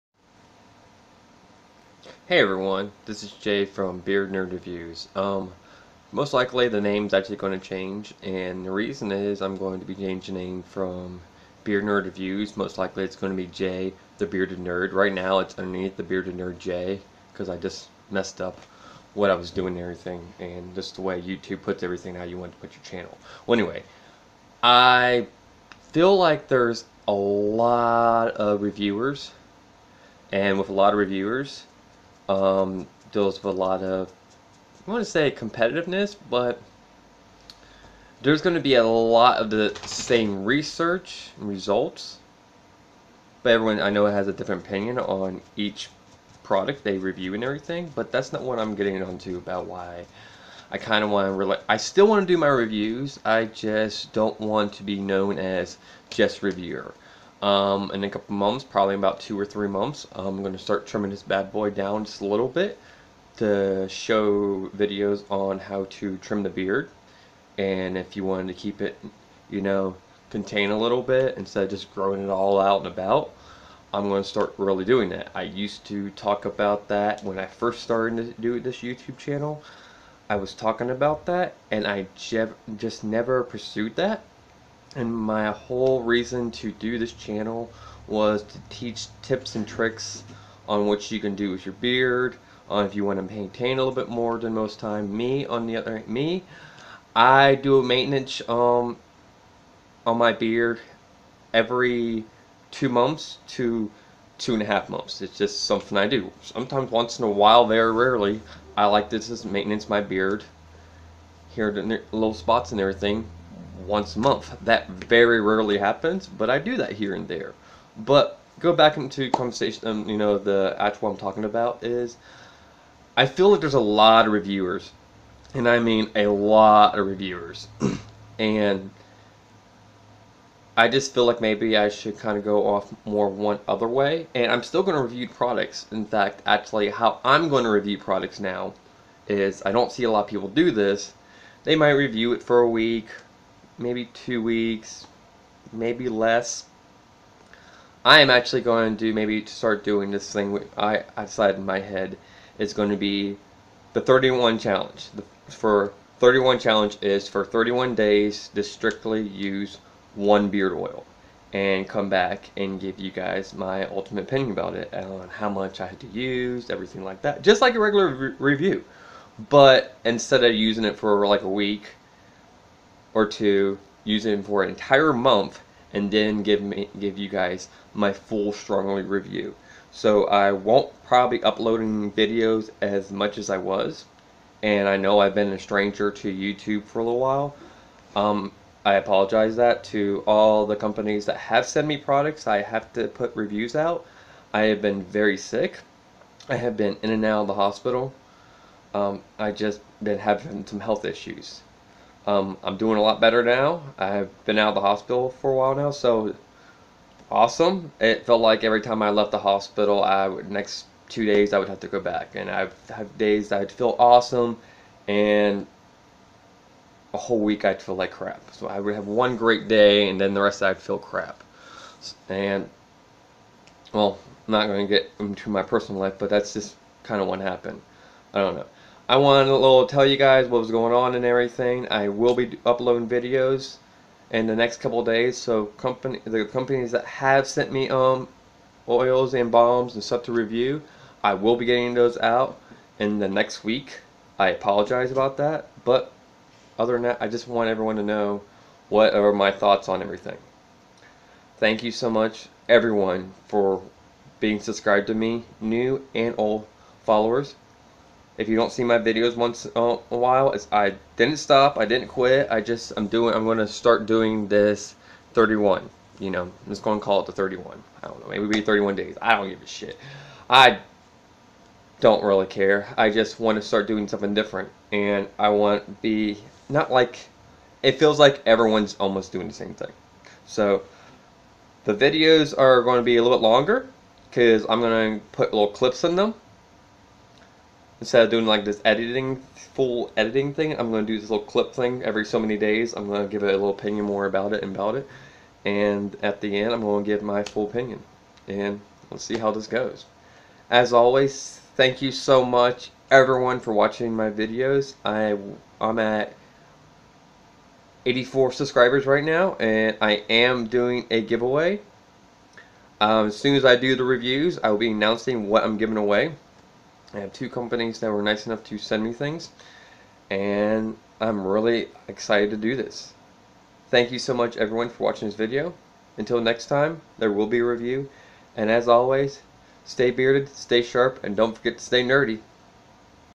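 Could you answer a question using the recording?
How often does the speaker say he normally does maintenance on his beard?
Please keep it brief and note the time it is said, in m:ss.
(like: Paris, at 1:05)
every 2 months, at 1:41.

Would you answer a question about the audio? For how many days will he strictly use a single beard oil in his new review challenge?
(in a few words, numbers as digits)
31.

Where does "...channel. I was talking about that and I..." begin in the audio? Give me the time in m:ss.
1:19.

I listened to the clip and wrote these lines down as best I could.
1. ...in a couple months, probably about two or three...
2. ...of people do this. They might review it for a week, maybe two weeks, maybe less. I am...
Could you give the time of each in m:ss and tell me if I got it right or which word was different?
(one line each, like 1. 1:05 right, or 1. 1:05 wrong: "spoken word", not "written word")
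1. 0:57 right
2. 2:20 right.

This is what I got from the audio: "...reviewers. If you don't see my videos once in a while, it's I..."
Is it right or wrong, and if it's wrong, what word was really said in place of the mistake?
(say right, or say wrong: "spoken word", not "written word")
wrong: "followers", not "reviewers".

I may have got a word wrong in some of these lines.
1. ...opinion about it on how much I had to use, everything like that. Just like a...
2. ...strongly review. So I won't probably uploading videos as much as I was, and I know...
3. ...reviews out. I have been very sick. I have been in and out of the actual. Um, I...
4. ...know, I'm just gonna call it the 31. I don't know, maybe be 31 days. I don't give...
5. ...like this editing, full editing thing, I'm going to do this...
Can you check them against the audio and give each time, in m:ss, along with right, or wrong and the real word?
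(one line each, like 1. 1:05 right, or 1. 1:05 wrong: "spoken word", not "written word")
1. 2:44 right
2. 2:58 right
3. 3:13 wrong: "hospital", not "actual"
4. 4:26 right
5. 4:48 right.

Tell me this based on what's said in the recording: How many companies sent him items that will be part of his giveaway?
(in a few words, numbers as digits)
2.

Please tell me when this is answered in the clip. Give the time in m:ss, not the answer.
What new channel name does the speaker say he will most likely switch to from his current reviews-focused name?
0:13.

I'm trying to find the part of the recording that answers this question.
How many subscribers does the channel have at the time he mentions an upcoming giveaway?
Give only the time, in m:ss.
5:08.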